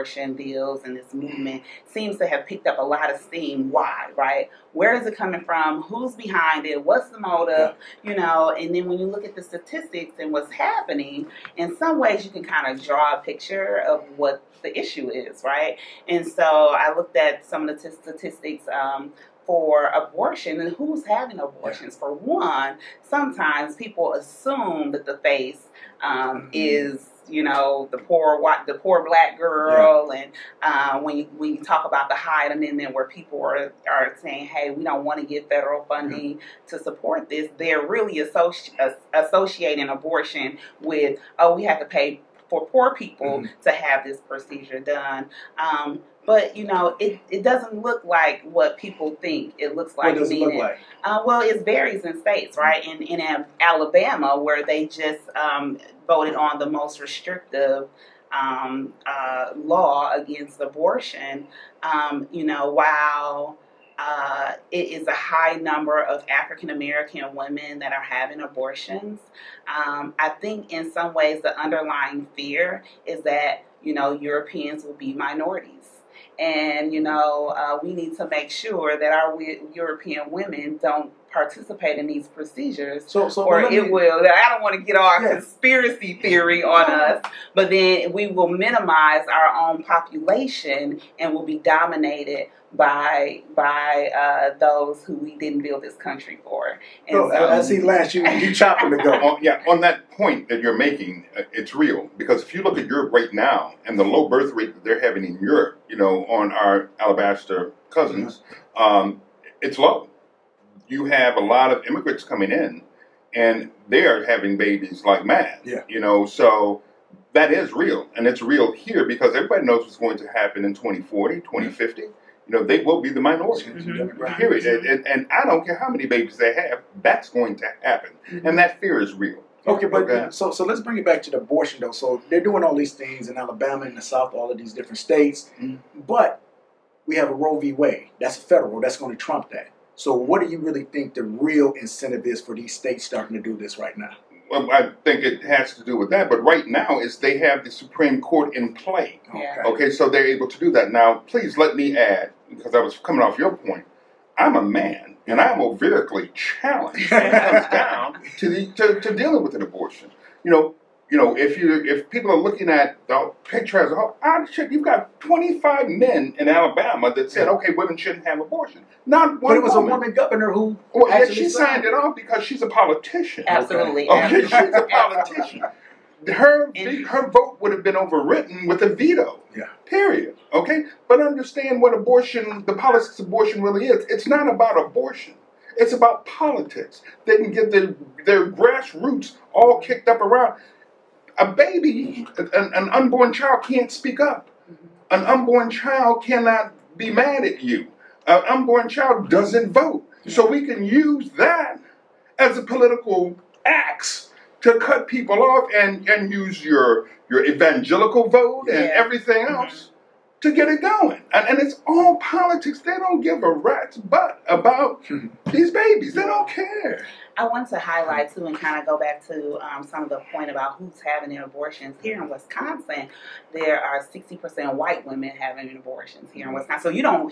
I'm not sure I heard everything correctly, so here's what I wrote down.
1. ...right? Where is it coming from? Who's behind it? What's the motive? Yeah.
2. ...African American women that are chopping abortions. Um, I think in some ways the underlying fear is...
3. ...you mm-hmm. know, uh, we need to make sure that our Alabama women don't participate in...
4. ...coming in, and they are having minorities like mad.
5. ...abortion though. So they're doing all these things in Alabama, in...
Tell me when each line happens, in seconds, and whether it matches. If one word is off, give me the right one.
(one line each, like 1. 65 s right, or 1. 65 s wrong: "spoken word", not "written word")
1. 4 s right
2. 66 s wrong: "having", not "chopping"
3. 76 s wrong: "European", not "Alabama"
4. 112 s wrong: "babies", not "minorities"
5. 131 s right.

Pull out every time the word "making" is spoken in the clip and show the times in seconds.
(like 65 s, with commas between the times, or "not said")
100 s.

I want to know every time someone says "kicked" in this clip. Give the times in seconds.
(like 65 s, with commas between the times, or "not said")
189 s.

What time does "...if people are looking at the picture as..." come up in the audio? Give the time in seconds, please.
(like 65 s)
161 s.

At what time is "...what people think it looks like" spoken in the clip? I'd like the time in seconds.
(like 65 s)
48 s.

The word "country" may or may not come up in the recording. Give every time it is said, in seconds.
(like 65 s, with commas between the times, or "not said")
95 s.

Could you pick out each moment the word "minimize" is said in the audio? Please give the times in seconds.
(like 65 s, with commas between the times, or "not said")
88 s.